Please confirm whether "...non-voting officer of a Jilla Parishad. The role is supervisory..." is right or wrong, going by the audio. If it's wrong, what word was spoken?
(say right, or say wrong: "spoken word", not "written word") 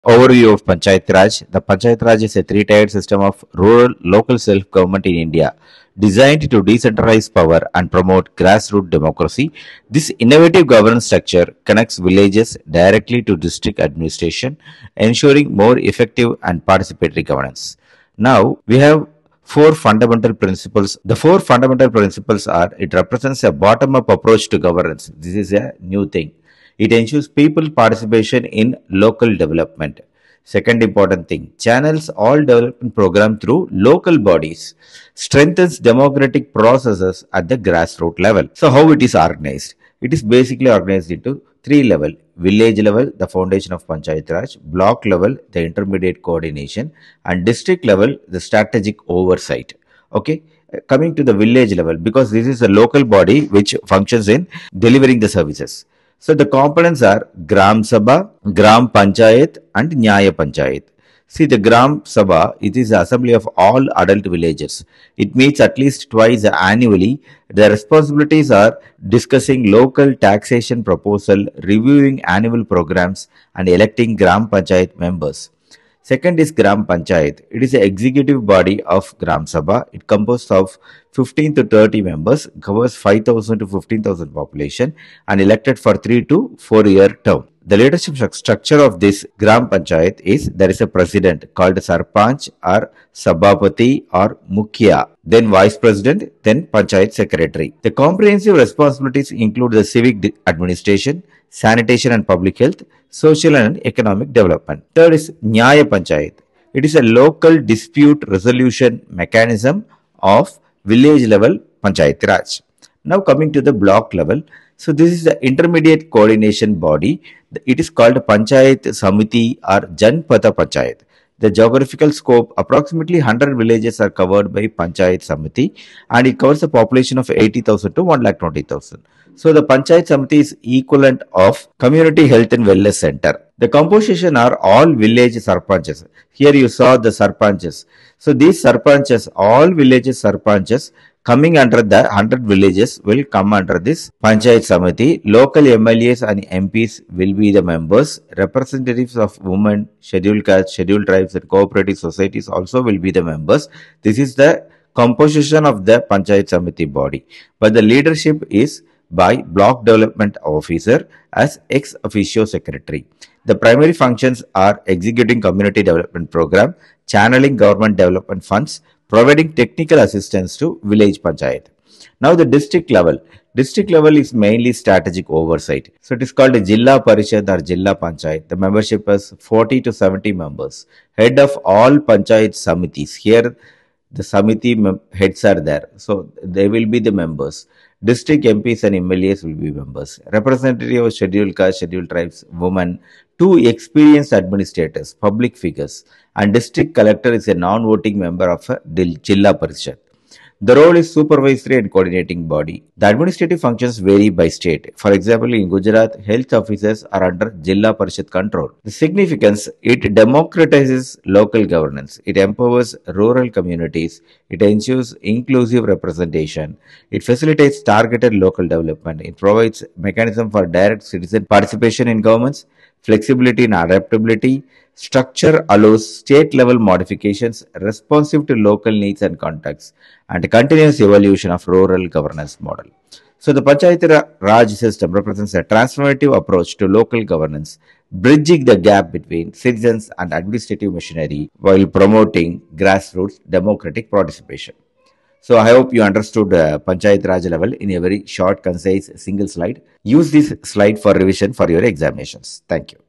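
wrong: "member", not "officer".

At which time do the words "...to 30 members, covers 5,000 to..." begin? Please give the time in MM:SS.
01:21.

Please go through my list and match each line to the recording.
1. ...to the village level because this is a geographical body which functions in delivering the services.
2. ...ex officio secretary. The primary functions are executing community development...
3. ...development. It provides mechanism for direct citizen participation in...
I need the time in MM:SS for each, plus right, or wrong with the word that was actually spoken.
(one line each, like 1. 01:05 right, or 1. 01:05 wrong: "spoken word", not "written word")
1. 00:51 wrong: "local", not "geographical"
2. 02:41 right
3. 03:38 right.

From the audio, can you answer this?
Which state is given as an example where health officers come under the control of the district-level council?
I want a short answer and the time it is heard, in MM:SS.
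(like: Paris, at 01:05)
Gujarat, at 03:25.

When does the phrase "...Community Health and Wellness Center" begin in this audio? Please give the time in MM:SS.
02:11.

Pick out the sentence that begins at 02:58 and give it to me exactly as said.
The membership is 40 to 70 members.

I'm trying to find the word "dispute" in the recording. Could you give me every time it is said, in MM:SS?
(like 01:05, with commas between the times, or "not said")
01:47.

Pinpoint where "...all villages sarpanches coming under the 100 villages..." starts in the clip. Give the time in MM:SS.
02:19.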